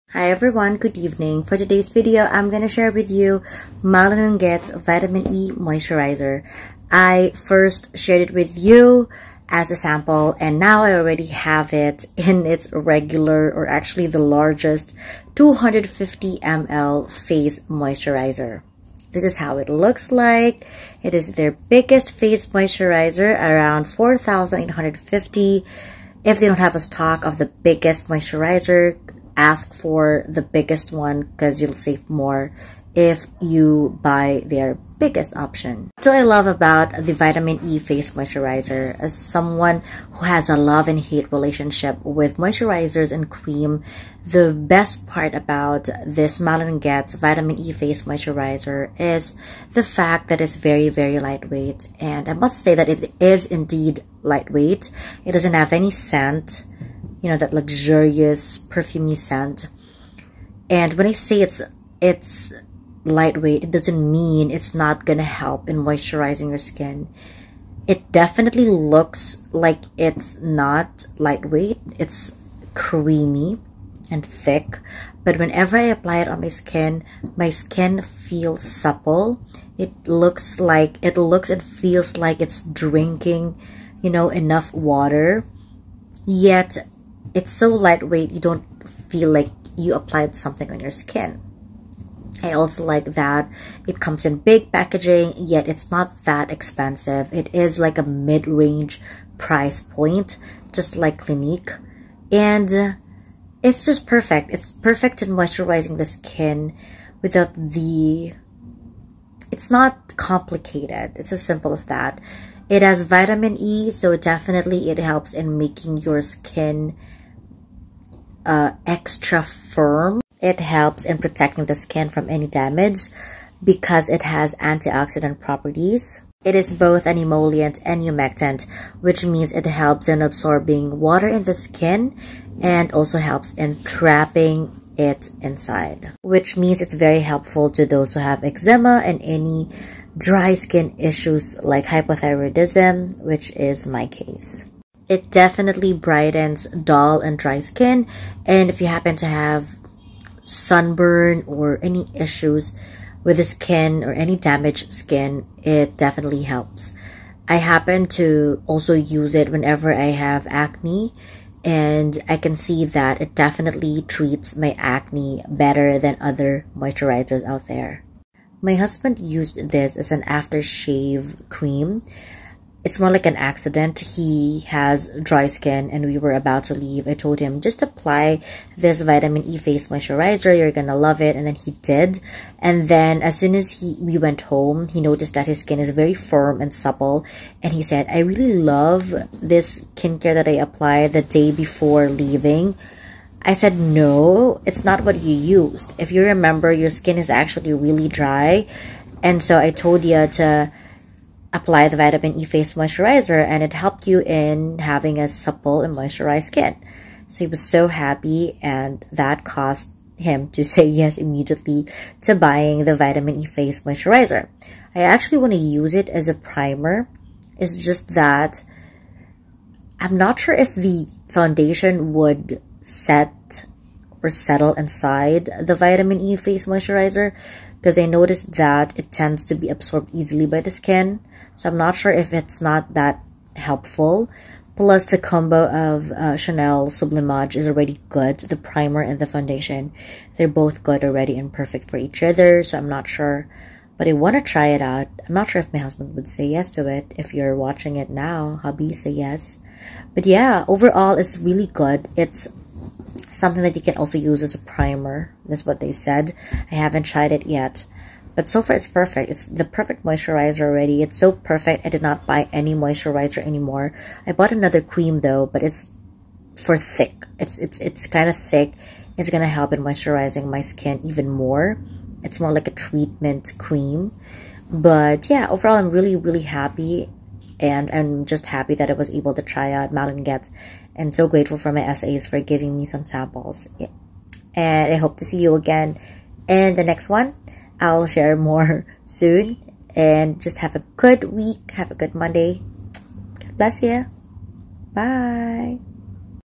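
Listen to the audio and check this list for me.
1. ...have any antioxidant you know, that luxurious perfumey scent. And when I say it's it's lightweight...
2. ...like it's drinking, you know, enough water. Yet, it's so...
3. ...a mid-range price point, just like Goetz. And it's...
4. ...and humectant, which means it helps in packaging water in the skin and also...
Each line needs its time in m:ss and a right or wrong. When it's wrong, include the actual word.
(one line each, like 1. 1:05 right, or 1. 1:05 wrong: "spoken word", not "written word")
1. 0:55 wrong: "scent", not "antioxidant"
2. 1:22 right
3. 1:37 wrong: "Clinique", not "Goetz"
4. 2:07 wrong: "absorbing", not "packaging".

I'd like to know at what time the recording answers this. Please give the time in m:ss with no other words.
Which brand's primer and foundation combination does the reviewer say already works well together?
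3:56.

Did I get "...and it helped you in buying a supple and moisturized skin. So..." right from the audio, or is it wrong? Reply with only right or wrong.
wrong.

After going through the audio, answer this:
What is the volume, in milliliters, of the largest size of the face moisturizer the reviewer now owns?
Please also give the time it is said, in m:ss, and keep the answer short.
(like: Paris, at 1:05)
250 ml, at 0:15.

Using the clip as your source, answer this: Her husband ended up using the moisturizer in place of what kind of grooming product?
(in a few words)
aftershave cream.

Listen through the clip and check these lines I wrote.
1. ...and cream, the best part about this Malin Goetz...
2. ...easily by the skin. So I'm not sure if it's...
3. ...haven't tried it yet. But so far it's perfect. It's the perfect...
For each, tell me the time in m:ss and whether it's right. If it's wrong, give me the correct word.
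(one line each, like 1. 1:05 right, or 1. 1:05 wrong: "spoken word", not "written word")
1. 0:43 right
2. 3:50 right
3. 4:16 right.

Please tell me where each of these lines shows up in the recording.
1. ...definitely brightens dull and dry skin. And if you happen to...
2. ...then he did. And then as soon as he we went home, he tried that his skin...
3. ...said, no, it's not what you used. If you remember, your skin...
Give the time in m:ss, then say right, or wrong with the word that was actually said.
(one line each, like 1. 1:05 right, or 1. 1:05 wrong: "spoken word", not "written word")
1. 2:25 right
2. 3:01 wrong: "noticed", not "tried"
3. 3:13 right.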